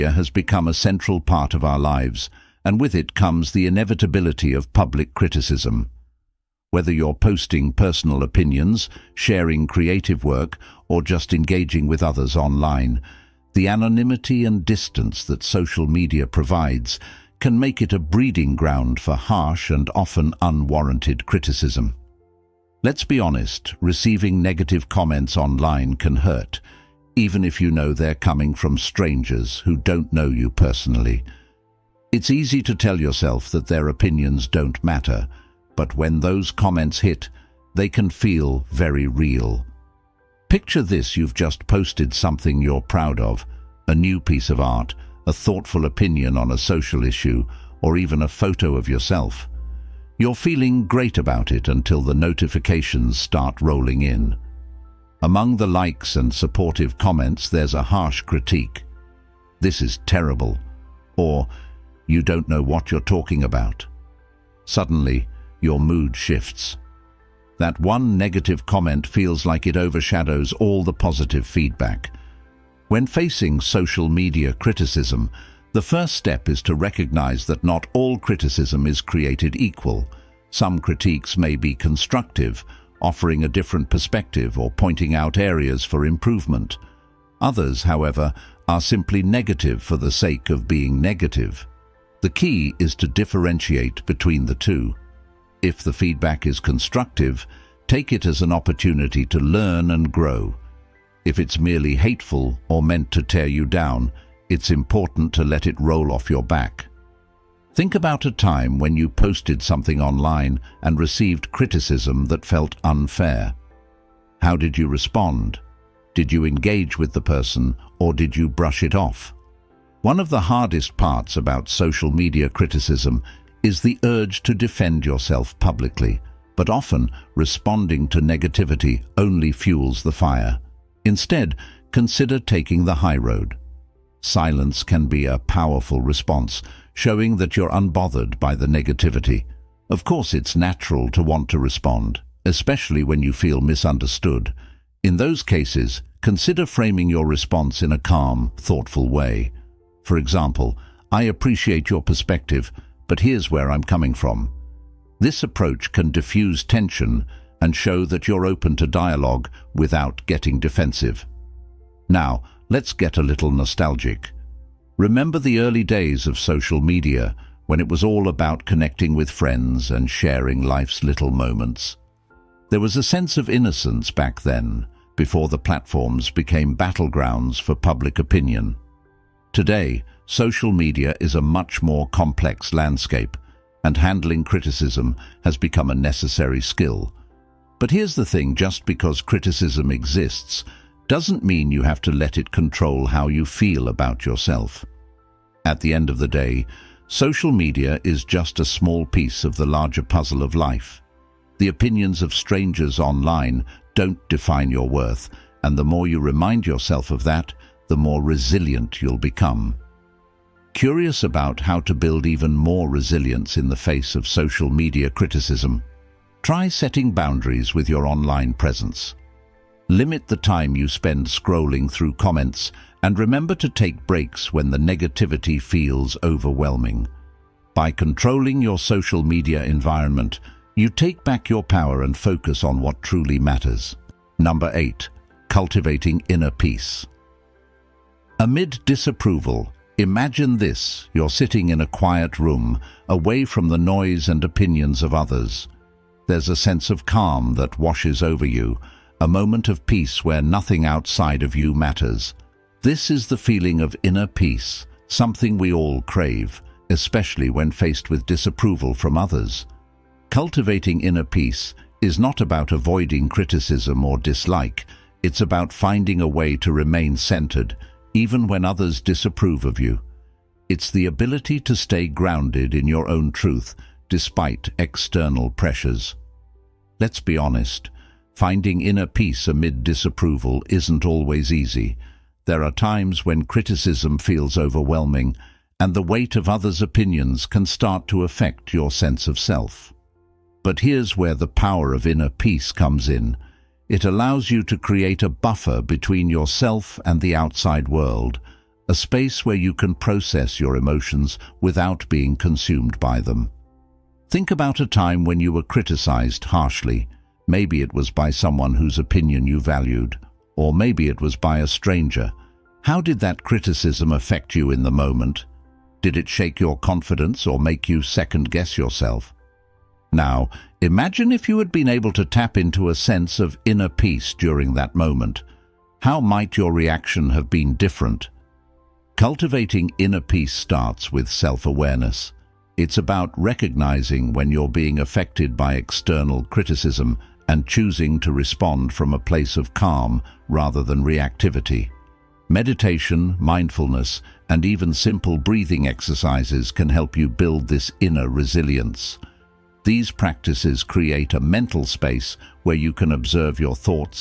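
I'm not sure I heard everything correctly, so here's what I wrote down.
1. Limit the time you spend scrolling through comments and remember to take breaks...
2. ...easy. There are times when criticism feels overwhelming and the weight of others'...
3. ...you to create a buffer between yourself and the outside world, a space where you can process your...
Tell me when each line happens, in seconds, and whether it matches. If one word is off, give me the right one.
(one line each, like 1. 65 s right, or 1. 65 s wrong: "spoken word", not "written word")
1. 219 s right
2. 281 s right
3. 294 s right.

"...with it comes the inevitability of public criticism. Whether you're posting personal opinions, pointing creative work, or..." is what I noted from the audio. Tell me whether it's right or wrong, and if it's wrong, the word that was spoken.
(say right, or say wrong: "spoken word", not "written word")
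wrong: "sharing", not "pointing".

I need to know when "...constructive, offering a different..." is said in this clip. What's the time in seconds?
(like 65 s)
81 s.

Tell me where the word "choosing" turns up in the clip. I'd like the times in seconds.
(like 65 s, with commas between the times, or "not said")
337 s.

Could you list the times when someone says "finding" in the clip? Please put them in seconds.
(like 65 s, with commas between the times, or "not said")
265 s, 278 s.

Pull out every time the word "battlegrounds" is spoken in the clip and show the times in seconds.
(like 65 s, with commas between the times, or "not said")
176 s.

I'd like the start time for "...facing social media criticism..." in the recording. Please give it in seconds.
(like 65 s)
73 s.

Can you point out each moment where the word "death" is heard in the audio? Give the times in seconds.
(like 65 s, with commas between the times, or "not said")
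not said.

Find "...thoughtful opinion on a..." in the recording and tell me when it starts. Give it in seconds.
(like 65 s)
45 s.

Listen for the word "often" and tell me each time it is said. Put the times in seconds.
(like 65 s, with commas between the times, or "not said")
19 s, 126 s.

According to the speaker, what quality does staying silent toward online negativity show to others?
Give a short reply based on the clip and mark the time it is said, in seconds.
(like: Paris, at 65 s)
Unbothered, at 137 s.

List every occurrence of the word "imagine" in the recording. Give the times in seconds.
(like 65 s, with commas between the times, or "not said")
239 s, 320 s.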